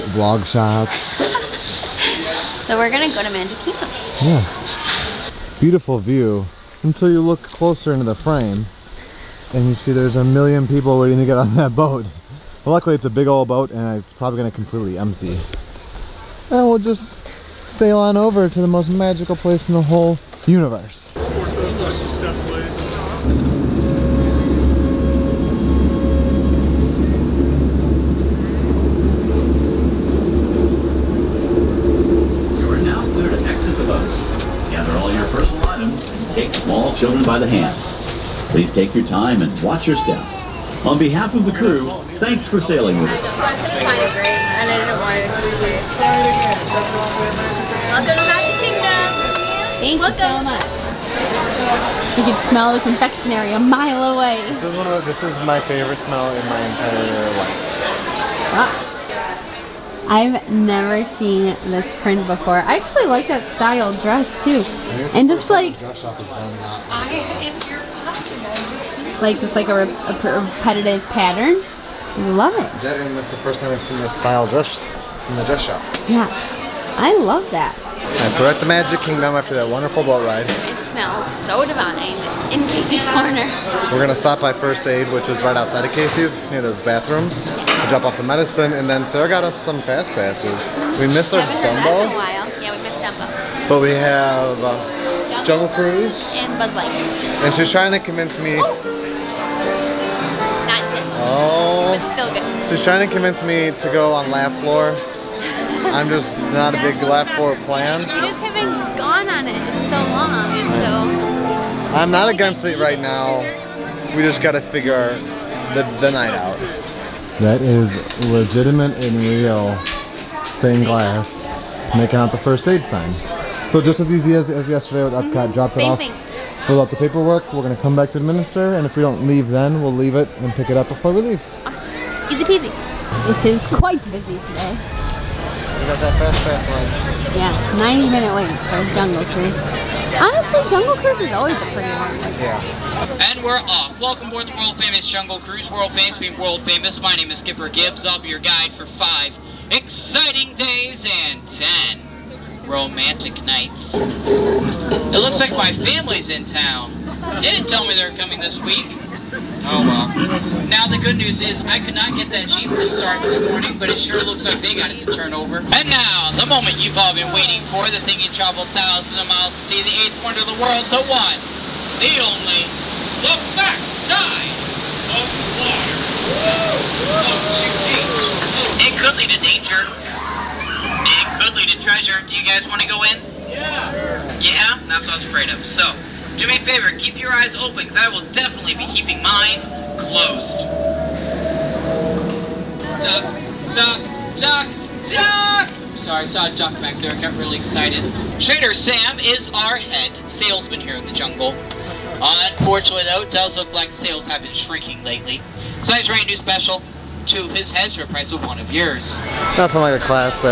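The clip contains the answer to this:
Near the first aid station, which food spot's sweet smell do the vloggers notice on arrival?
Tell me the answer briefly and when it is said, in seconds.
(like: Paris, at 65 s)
Casey's Corner, at 82 s.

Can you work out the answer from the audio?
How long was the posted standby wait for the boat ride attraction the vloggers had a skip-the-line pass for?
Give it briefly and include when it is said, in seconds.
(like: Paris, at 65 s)
90 minutes, at 137 s.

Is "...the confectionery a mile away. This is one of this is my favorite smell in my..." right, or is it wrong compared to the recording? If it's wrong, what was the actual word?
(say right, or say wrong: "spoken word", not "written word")
right.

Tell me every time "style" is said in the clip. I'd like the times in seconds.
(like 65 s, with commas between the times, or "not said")
63 s, 74 s.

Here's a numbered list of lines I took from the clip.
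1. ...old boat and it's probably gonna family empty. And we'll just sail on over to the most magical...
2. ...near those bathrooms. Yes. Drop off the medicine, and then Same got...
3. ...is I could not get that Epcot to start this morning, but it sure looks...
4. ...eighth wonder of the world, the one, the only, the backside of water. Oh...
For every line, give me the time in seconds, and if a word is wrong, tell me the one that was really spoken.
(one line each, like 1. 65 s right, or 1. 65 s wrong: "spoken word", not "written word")
1. 13 s wrong: "completely", not "family"
2. 86 s wrong: "Sarah", not "Same"
3. 161 s wrong: "Jeep", not "Epcot"
4. 170 s right.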